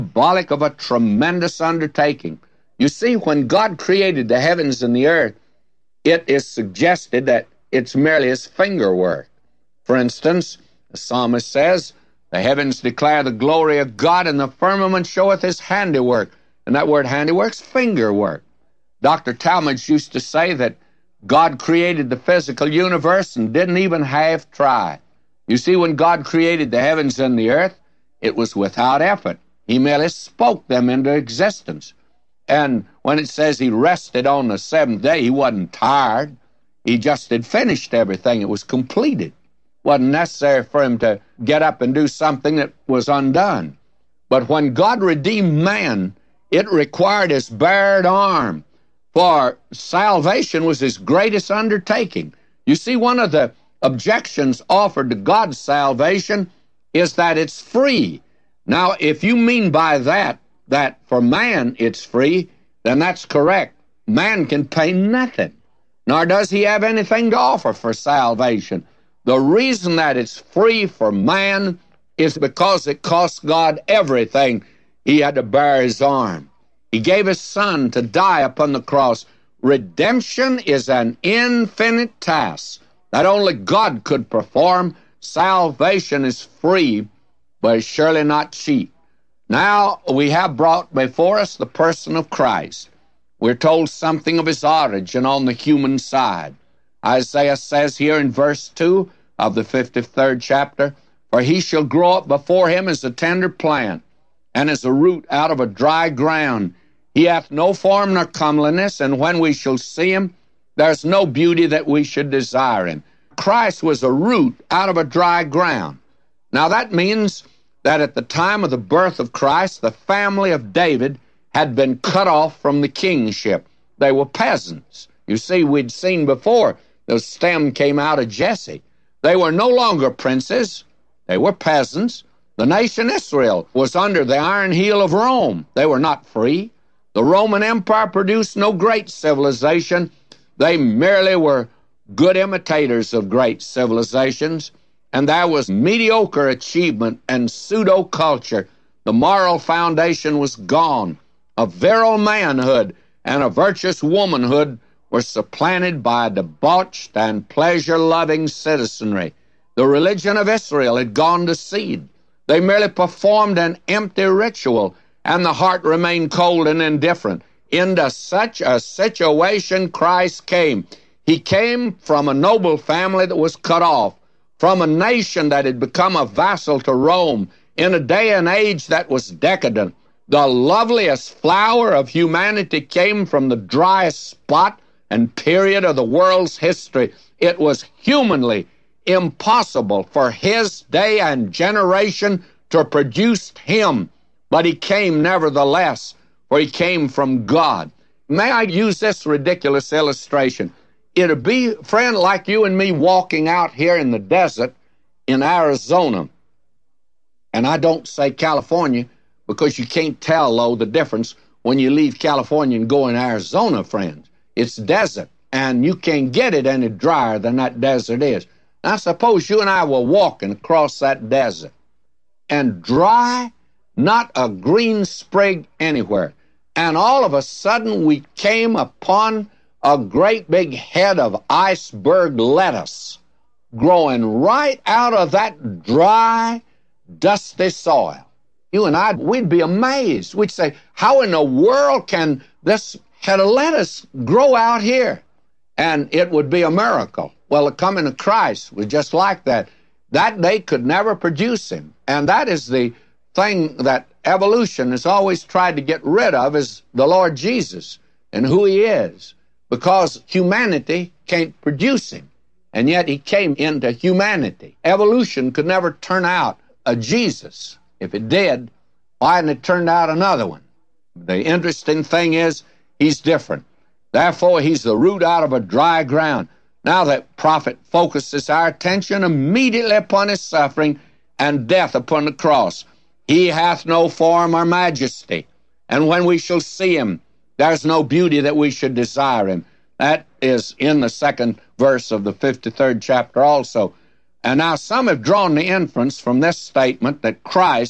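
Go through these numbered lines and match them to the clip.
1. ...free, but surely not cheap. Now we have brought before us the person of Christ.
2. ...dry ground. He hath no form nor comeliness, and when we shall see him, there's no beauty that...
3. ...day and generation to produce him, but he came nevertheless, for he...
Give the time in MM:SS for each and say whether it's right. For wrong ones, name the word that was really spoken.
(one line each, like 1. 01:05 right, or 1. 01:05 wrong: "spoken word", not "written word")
1. 01:26 right
2. 01:45 right
3. 03:10 right.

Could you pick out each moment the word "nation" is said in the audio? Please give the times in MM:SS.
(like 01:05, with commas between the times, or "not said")
02:12, 02:54.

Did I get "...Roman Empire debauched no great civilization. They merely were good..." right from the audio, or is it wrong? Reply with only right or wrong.
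wrong.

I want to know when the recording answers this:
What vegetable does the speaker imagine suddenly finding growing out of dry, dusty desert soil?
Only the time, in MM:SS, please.
03:51.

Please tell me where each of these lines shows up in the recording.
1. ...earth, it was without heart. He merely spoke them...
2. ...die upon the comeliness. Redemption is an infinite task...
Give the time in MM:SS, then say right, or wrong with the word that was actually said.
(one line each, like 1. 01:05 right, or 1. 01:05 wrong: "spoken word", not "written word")
1. 00:27 wrong: "effort", not "heart"
2. 01:18 wrong: "cross", not "comeliness".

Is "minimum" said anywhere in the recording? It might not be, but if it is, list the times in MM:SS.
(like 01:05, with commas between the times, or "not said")
not said.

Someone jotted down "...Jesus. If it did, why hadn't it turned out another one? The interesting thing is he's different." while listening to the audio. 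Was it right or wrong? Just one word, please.
right.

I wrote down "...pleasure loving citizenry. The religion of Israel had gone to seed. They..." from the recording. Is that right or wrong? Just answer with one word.
right.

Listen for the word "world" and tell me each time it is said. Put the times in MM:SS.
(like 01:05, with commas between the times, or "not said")
03:06, 04:01.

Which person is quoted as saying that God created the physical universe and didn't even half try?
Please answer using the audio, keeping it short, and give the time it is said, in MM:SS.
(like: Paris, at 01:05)
Dr. Talmage, at 00:18.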